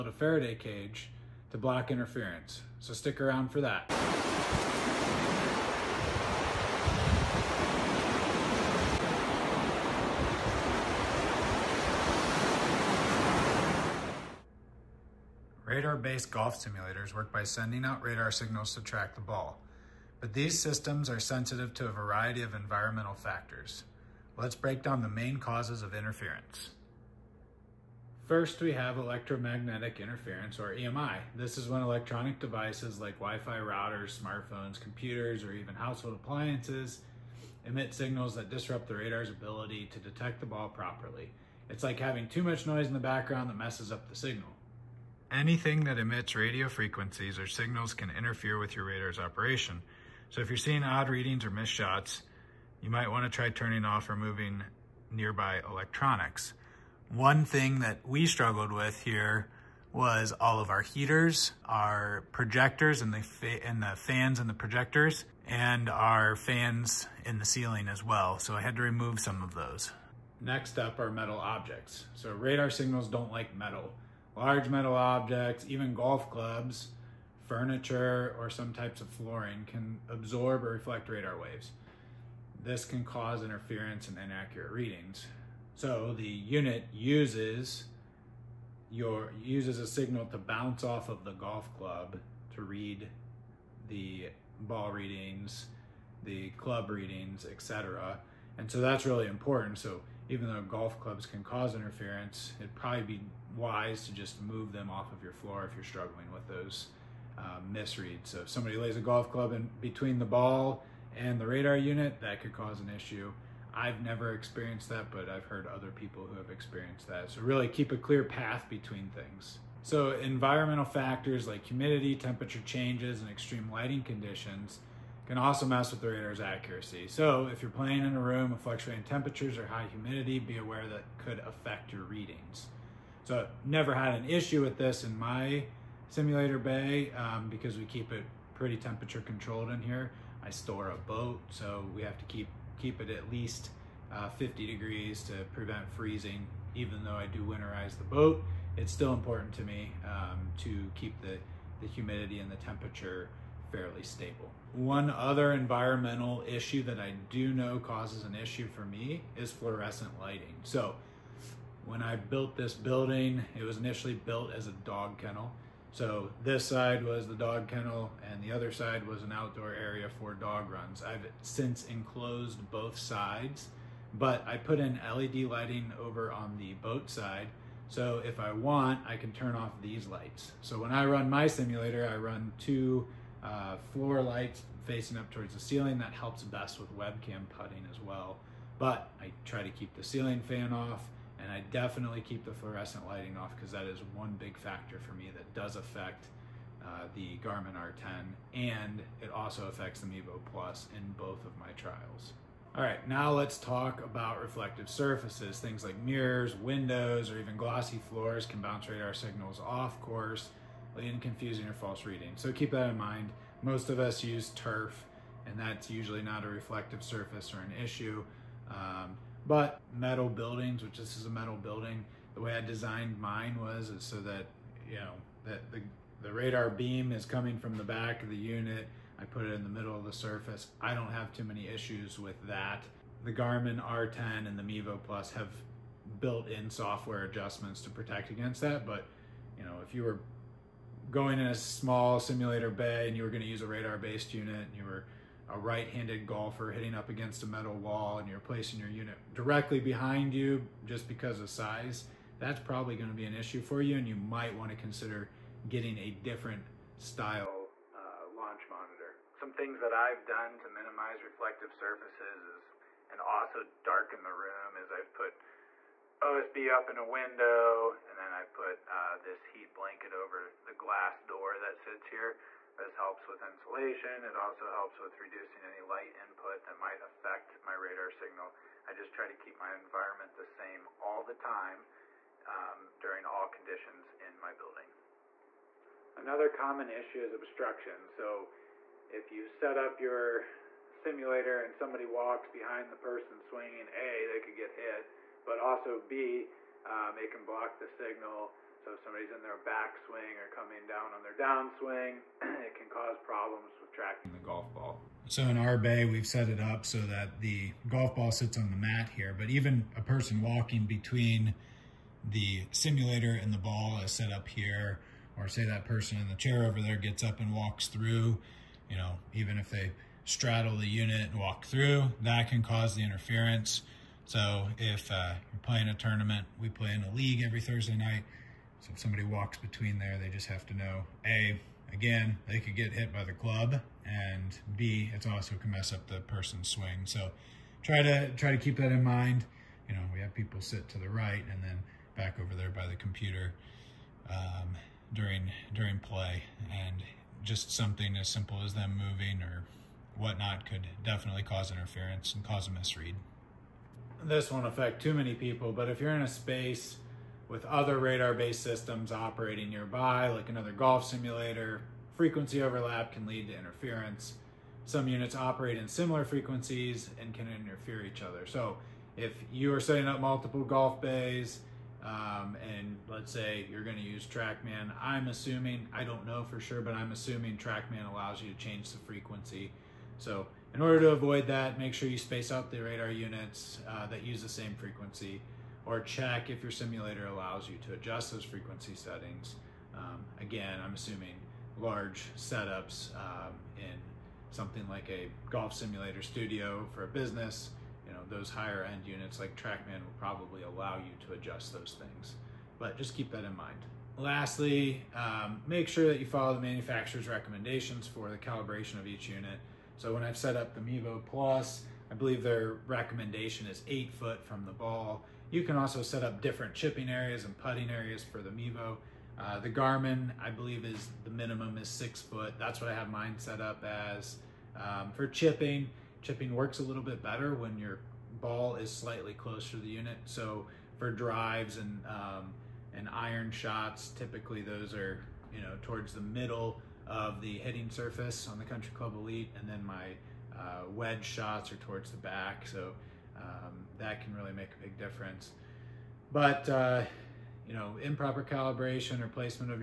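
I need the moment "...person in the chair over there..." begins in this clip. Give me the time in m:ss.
5:15.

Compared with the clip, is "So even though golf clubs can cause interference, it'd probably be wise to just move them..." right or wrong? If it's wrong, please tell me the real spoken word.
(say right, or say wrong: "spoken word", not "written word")
right.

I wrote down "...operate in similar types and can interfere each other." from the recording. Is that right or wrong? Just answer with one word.
wrong.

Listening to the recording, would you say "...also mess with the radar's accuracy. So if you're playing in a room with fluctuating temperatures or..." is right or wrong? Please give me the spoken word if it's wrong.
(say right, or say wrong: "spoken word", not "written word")
right.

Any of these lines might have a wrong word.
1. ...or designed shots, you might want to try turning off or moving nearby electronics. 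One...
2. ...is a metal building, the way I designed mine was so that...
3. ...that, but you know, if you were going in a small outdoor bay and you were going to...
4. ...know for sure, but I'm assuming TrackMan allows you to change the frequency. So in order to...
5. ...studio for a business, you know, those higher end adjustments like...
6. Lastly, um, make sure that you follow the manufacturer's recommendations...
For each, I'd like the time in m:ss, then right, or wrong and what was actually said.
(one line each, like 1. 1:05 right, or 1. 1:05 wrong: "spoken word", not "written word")
1. 0:51 wrong: "missed", not "designed"
2. 3:41 right
3. 3:58 wrong: "simulator", not "outdoor"
4. 6:16 right
5. 6:36 wrong: "units", not "adjustments"
6. 6:44 right.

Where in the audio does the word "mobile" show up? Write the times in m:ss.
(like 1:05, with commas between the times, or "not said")
not said.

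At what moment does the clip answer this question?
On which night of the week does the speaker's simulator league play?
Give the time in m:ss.
5:27.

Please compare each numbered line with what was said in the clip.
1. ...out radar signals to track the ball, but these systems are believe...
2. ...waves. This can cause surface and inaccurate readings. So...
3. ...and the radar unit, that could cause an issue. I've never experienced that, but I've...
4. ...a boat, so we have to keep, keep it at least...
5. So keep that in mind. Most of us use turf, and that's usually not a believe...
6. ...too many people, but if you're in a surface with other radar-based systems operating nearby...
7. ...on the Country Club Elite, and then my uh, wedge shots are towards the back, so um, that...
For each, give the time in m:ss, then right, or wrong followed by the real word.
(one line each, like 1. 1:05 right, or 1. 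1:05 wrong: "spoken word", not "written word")
1. 0:17 wrong: "sensitive", not "believe"
2. 1:21 wrong: "interference", not "surface"
3. 1:51 right
4. 2:20 right
5. 3:32 wrong: "reflective", not "believe"
6. 5:55 wrong: "space", not "surface"
7. 7:18 right.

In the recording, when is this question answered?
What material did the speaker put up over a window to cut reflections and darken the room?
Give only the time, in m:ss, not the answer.
4:26.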